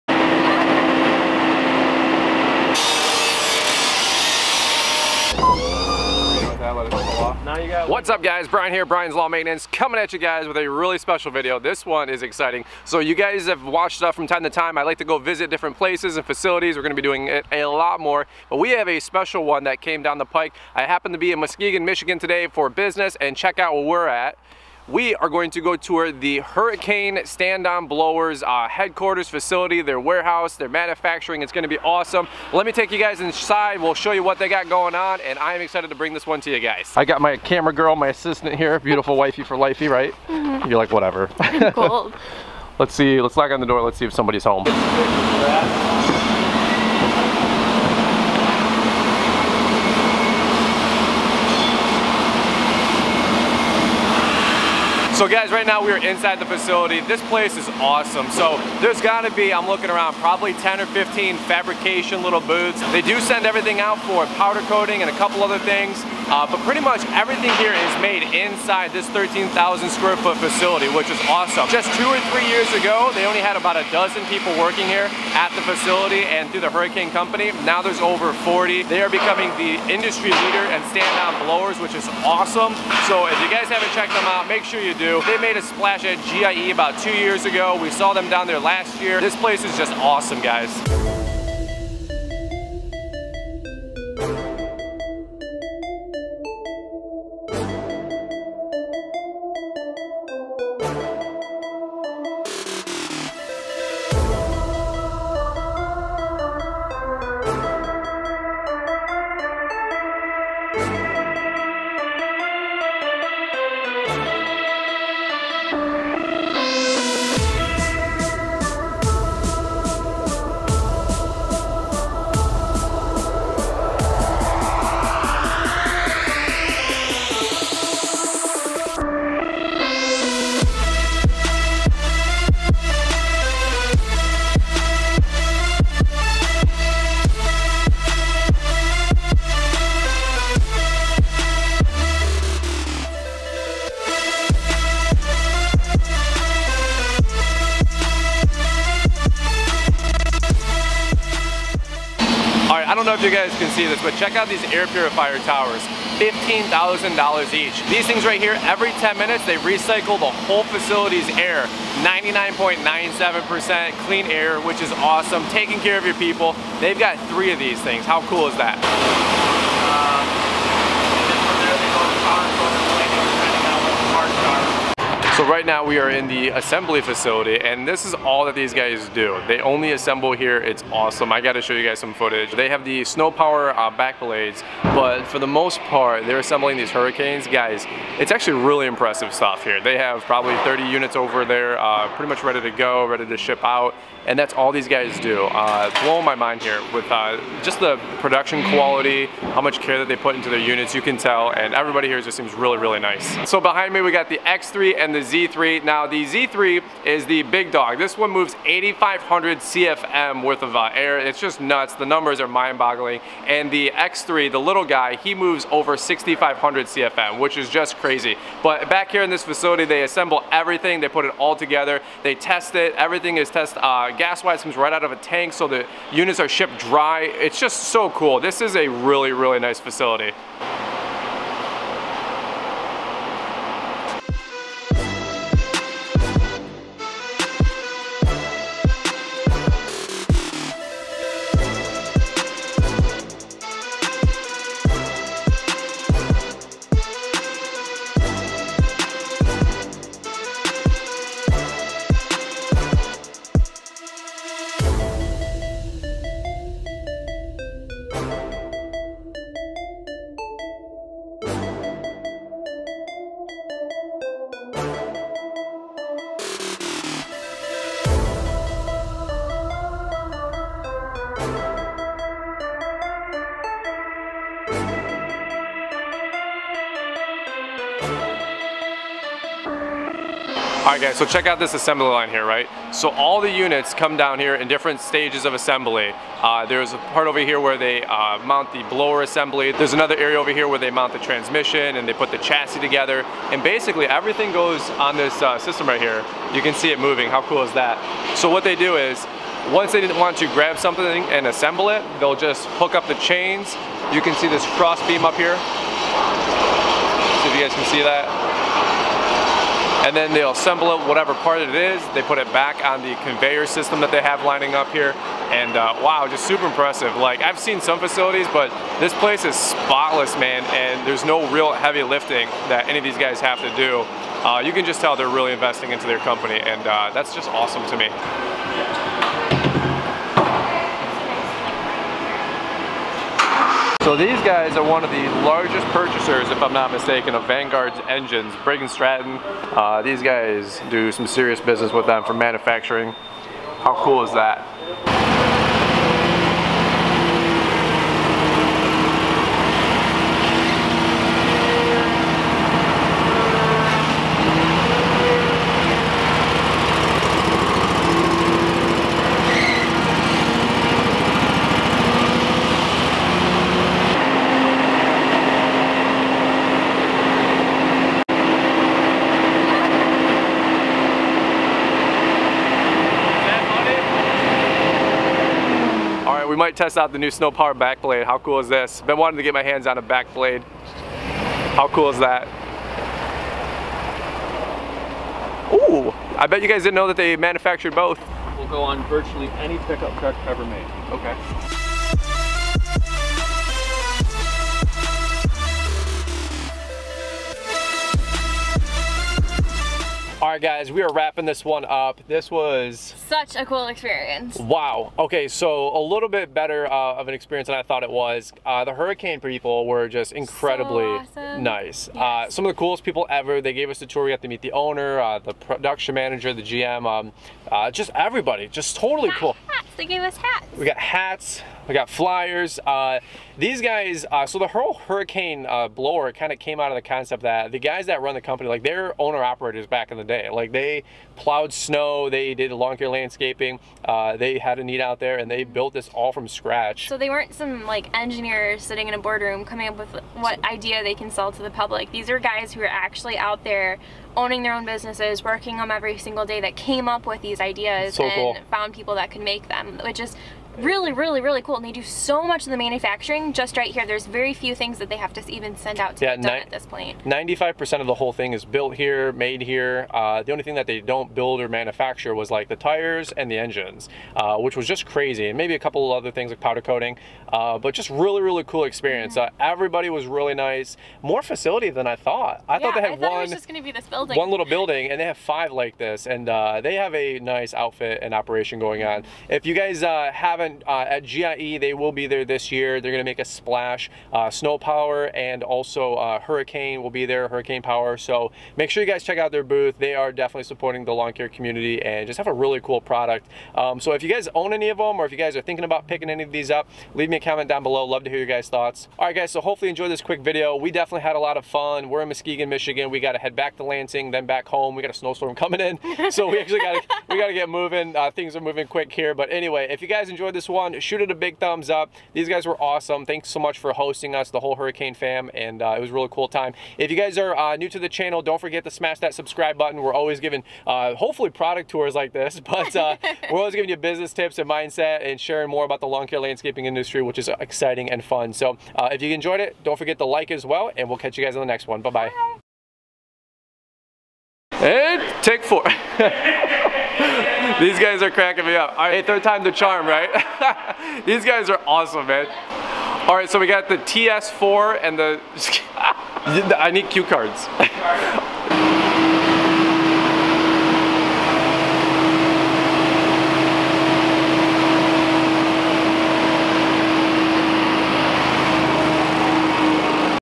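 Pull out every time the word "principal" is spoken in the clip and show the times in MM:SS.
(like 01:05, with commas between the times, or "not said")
not said.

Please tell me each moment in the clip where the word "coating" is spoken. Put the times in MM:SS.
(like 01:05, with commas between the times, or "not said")
01:04, 07:46.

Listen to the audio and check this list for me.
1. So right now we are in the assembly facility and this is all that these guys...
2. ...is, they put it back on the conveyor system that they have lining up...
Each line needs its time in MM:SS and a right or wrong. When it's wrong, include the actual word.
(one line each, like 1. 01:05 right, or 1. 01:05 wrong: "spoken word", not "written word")
1. 02:55 right
2. 05:11 right.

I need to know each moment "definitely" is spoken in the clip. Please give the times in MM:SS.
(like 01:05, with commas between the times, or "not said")
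08:10, 08:20.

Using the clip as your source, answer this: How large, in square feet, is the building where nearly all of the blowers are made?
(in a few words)
13,000.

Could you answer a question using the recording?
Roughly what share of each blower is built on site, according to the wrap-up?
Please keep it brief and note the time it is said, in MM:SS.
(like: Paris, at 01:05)
95%, at 07:37.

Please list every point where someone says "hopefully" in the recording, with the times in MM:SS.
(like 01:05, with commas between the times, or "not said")
08:19, 08:41.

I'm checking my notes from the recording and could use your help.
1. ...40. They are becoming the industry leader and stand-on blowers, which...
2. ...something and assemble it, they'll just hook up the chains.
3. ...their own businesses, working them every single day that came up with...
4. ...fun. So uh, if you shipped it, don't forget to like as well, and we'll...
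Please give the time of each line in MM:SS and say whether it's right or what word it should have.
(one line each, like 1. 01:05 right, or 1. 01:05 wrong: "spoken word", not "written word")
1. 01:18 right
2. 05:00 right
3. 07:24 right
4. 08:48 wrong: "enjoyed", not "shipped".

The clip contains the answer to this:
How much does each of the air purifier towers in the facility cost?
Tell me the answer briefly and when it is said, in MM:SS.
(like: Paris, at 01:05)
$15,000, at 02:36.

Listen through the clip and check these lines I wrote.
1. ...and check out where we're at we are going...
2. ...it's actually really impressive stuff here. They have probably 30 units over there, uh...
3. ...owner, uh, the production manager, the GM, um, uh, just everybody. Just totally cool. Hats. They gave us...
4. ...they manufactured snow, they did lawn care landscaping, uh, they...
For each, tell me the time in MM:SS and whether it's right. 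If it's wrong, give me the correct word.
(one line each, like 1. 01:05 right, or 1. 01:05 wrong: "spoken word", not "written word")
1. 00:23 right
2. 03:08 right
3. 06:54 right
4. 07:10 wrong: "plowed", not "manufactured".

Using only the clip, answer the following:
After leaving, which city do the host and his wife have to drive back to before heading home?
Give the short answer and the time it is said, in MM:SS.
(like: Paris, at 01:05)
Lansing, at 08:23.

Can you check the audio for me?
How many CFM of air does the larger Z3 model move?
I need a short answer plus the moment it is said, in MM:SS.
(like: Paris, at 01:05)
8,500, at 03:28.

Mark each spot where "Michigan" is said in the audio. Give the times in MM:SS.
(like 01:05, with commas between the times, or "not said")
00:21, 08:22.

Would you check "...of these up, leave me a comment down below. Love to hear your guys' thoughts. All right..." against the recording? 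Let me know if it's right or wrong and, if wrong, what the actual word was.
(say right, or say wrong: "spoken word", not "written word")
right.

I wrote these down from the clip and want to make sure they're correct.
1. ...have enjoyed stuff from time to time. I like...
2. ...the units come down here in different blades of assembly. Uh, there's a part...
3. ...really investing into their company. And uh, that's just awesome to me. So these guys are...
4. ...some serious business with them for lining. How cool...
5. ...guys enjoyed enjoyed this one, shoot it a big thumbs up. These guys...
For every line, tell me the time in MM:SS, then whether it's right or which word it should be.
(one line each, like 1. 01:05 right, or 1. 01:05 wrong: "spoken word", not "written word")
1. 00:13 wrong: "watched", not "enjoyed"
2. 04:43 wrong: "stages", not "blades"
3. 05:25 right
4. 05:41 wrong: "manufacturing", not "lining"
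5. 08:30 right.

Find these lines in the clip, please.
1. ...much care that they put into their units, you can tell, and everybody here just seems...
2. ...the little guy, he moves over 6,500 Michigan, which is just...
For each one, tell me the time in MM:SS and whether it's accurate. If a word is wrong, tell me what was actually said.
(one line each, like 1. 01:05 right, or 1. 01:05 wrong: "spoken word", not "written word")
1. 03:19 right
2. 03:34 wrong: "CFM", not "Michigan".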